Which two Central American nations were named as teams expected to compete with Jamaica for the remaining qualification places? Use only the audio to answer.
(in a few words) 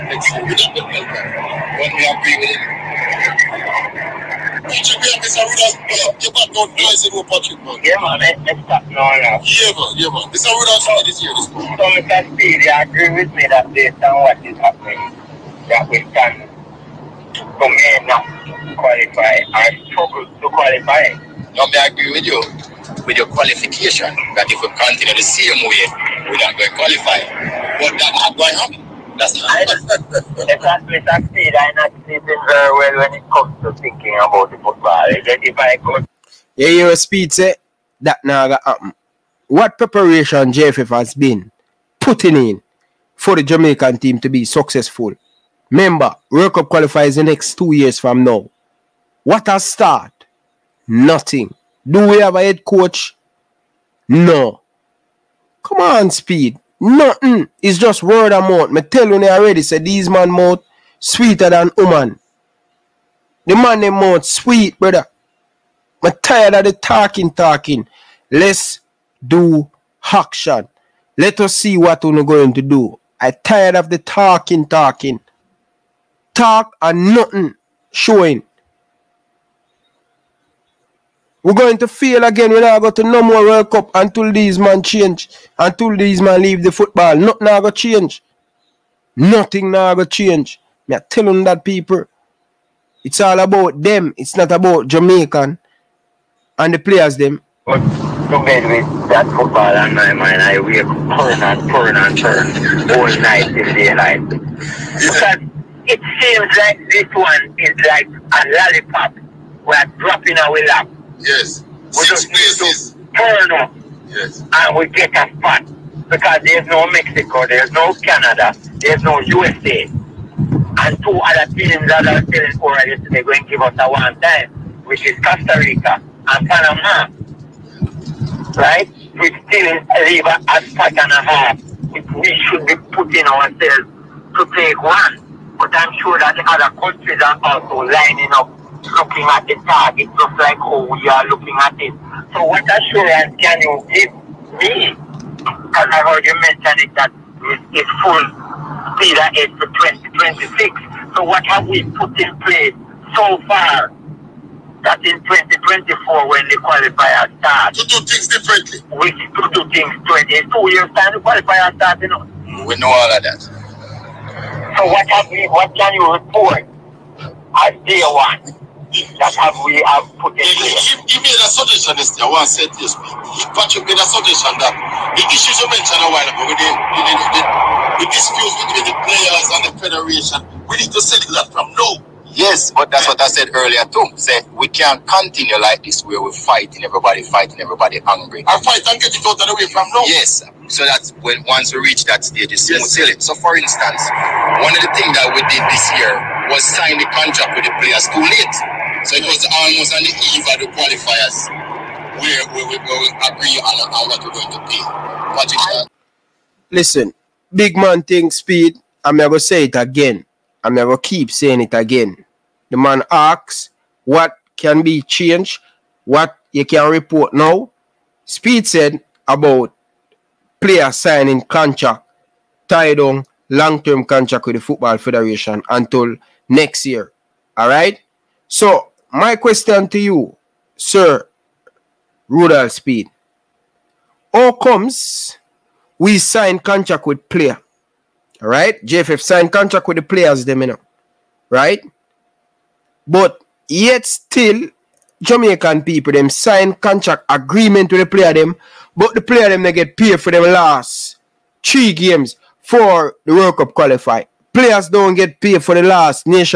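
Costa Rica and Panama.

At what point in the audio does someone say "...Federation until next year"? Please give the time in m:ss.
3:44.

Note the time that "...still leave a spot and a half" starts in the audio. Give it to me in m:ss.
2:09.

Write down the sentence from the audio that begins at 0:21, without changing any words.
No, I agree with you with your qualification that if we continue the same way, we're not going to qualify.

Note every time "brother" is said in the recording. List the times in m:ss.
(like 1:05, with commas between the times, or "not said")
1:04.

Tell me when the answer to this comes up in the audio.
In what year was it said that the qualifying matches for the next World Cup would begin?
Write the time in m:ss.
2:35.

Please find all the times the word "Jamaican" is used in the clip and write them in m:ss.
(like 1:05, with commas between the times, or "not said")
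0:43, 1:34, 4:05.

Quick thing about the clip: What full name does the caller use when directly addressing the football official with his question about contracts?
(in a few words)
Sir Rudolph Speid.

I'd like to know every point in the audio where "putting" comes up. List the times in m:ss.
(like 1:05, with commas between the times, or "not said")
0:41, 2:12.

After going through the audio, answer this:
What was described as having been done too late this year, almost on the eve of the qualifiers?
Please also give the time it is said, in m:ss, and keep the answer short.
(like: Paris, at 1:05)
sign the contract with the players, at 3:16.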